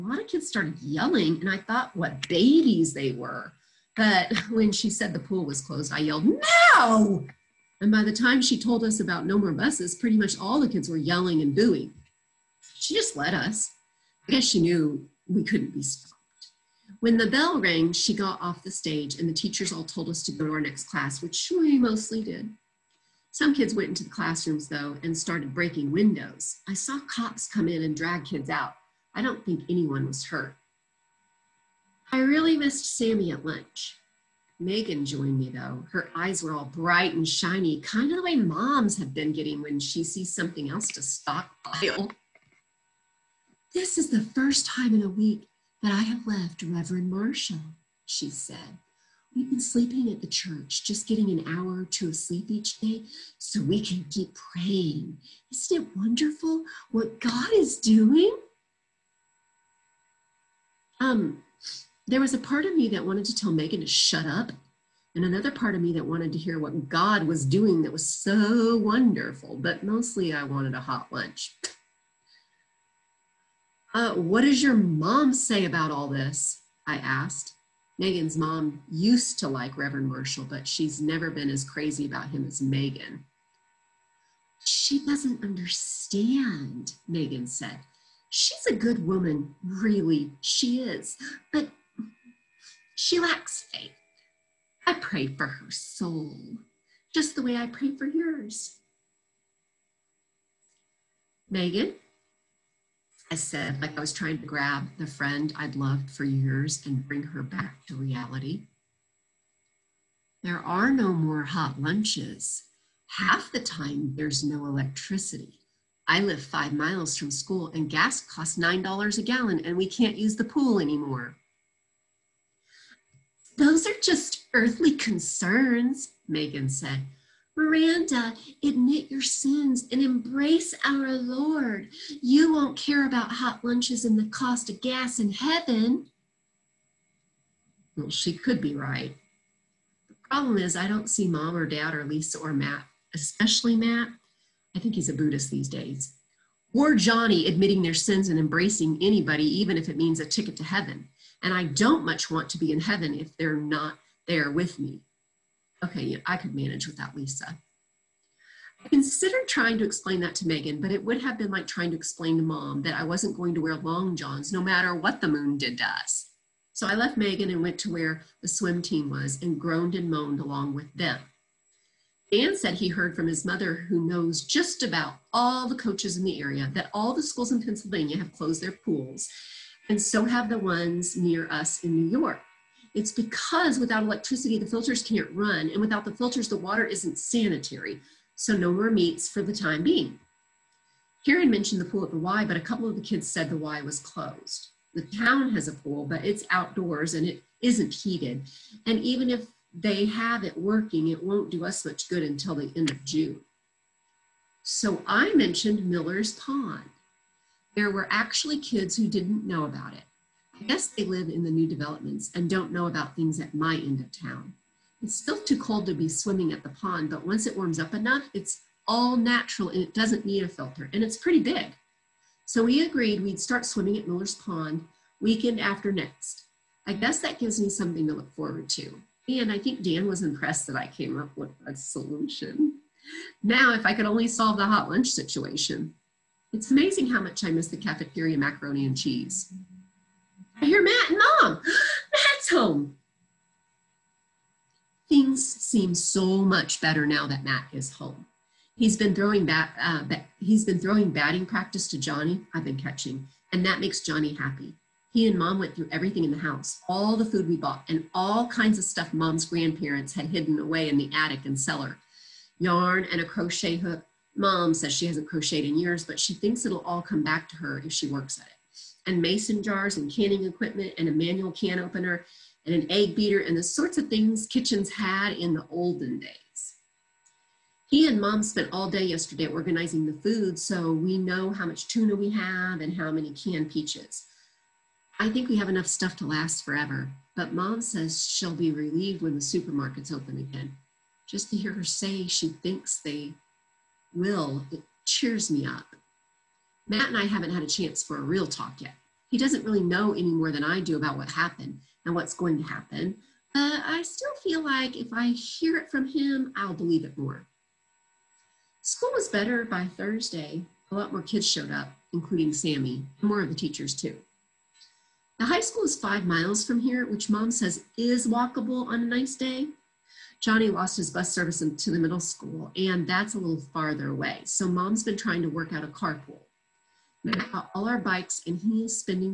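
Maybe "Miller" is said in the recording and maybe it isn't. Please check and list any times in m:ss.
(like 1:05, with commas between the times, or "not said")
3:25, 3:44.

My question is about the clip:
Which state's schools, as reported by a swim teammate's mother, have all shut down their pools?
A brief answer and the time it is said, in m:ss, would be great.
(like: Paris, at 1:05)
Pennsylvania, at 2:57.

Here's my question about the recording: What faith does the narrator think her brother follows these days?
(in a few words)
Buddhist.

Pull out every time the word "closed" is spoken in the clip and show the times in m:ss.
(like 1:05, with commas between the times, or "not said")
0:05, 2:58, 3:13.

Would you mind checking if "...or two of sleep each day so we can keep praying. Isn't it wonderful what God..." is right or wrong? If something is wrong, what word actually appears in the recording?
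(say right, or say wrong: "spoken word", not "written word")
right.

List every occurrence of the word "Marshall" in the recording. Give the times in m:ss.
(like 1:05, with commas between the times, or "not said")
0:47, 1:20.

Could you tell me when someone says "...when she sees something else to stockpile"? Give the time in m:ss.
0:39.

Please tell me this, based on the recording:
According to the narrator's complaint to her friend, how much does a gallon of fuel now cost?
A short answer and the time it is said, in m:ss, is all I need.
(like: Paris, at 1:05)
$9, at 1:58.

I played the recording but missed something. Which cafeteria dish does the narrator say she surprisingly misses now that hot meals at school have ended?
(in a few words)
Macaroni and cheese.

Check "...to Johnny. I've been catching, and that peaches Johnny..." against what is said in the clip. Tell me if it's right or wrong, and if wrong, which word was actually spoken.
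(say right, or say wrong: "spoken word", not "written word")
wrong: "makes", not "peaches".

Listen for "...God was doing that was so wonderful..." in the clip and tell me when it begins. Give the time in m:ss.
1:06.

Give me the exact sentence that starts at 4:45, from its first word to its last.
I think we have enough stuff to last forever, but mom says she'll be relieved when the supermarket's open again.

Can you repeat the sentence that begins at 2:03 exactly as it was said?
Those are just earthly concerns, Megan said.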